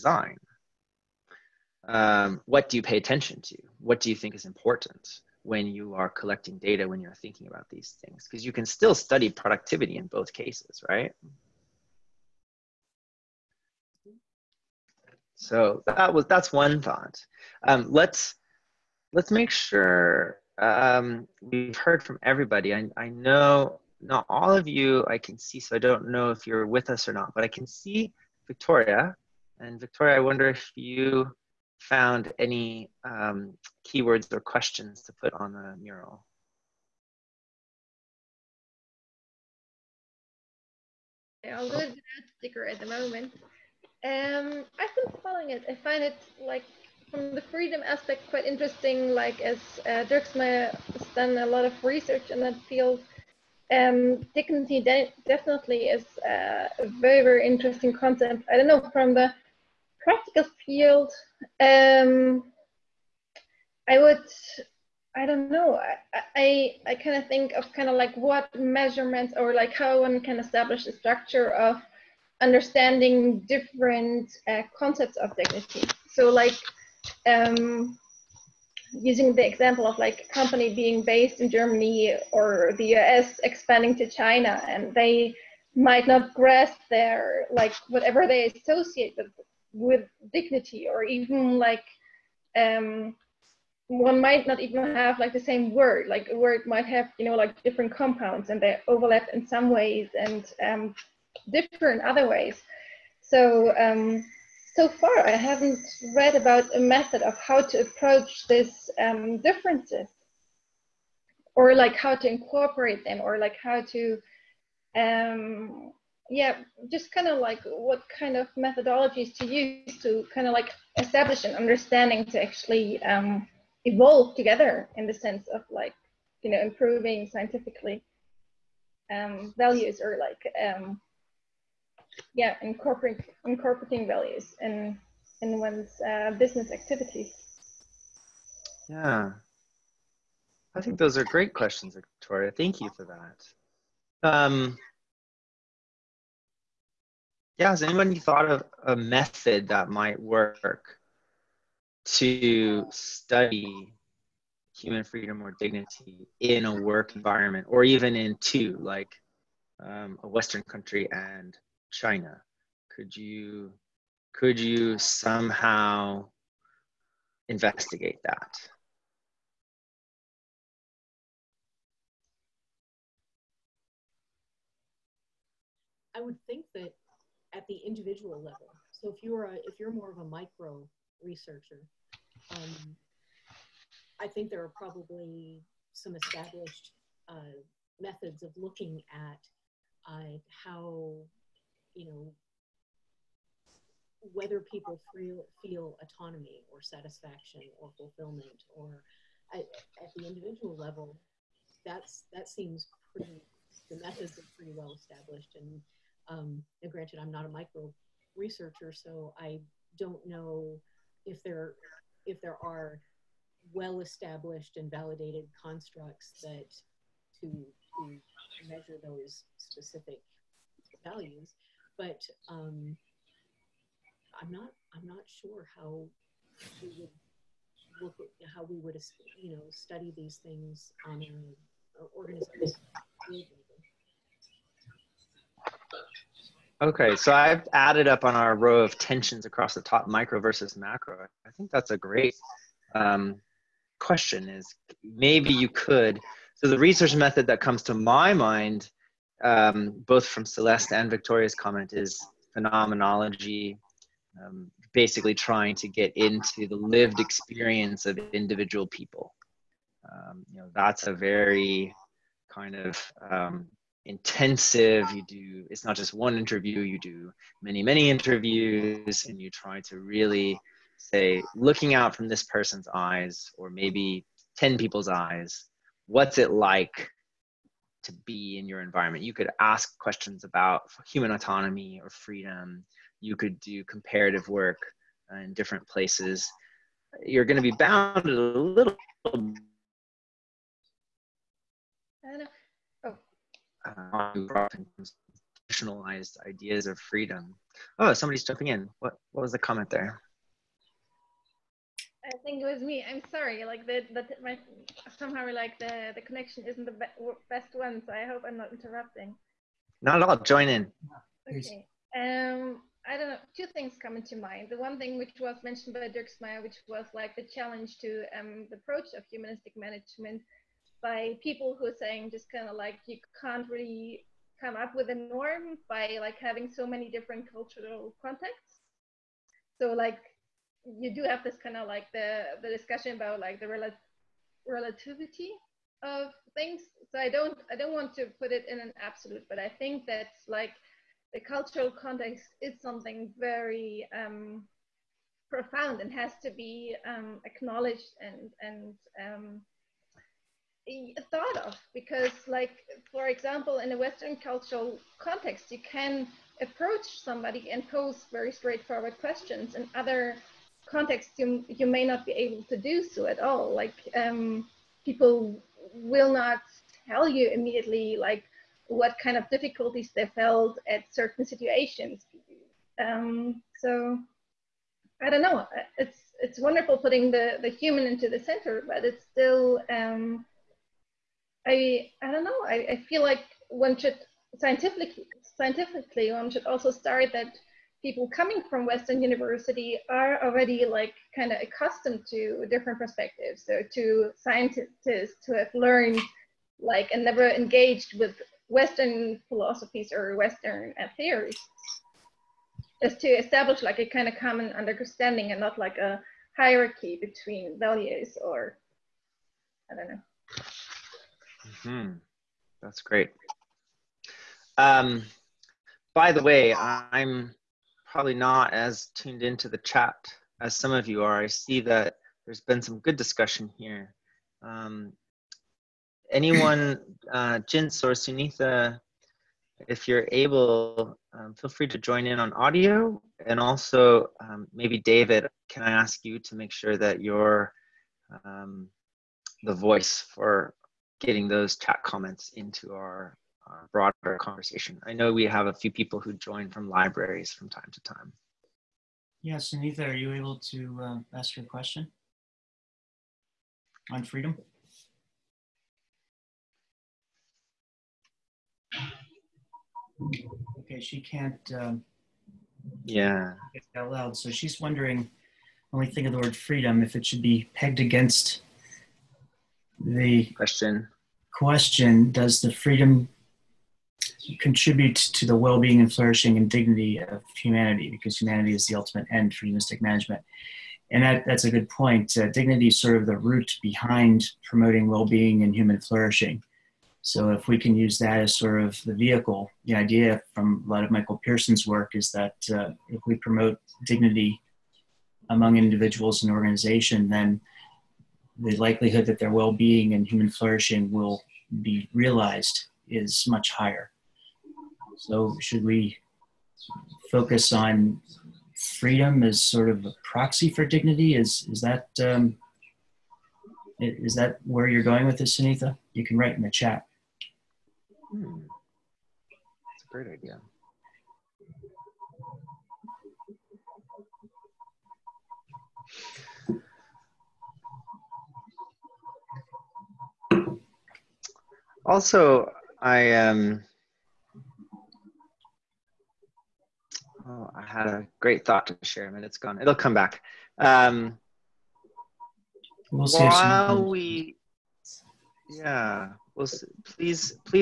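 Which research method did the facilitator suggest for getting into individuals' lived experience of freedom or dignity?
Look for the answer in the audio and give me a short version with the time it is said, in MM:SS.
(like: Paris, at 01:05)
Phenomenology, at 04:12.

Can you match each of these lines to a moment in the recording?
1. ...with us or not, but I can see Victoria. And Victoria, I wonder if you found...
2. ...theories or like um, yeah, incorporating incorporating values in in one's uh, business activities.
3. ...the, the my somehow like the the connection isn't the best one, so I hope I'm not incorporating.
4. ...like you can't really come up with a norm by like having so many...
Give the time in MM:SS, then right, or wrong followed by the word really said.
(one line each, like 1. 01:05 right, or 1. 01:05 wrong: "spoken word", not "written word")
1. 00:26 right
2. 02:09 wrong: "values", not "theories"
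3. 05:03 wrong: "interrupting", not "incorporating"
4. 05:22 right.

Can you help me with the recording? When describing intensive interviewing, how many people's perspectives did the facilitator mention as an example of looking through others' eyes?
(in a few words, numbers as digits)
10.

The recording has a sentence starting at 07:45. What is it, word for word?
Only think of the word freedom if it should be pegged against the question.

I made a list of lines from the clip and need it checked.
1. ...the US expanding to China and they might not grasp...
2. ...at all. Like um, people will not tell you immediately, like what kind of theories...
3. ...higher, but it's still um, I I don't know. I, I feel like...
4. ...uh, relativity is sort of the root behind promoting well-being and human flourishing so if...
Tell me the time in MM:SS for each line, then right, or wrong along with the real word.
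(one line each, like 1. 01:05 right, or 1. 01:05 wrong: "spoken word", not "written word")
1. 01:22 right
2. 06:03 wrong: "difficulties", not "theories"
3. 06:18 wrong: "center", not "higher"
4. 08:02 wrong: "dignity", not "relativity".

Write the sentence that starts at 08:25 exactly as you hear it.
So should we focus on freedom as sort of a proxy for dignity?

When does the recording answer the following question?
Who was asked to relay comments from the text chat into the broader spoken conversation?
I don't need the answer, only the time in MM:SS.
07:14.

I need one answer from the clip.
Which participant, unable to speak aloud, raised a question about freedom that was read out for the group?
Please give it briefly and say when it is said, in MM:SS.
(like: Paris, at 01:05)
Anita, at 07:29.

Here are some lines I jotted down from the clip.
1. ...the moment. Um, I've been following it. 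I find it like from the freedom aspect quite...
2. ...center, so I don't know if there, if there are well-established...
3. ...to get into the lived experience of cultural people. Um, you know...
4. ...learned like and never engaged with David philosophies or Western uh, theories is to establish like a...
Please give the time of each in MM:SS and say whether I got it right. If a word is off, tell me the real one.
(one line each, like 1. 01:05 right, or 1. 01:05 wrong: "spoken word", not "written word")
1. 00:42 right
2. 03:28 wrong: "researcher", not "center"
3. 04:15 wrong: "individual", not "cultural"
4. 06:35 wrong: "Western", not "David".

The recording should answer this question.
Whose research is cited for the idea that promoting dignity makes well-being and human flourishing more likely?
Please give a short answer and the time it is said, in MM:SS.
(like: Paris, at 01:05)
Michael Pirson, at 08:11.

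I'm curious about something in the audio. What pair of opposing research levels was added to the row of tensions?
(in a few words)
Micro versus macro.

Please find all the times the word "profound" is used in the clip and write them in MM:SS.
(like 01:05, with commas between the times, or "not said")
05:45.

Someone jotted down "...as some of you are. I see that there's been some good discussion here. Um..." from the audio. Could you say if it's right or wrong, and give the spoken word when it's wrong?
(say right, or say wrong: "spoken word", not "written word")
right.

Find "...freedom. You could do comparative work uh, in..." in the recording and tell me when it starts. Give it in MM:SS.
04:42.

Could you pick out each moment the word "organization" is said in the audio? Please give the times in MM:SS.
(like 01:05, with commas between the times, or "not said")
03:52, 08:16.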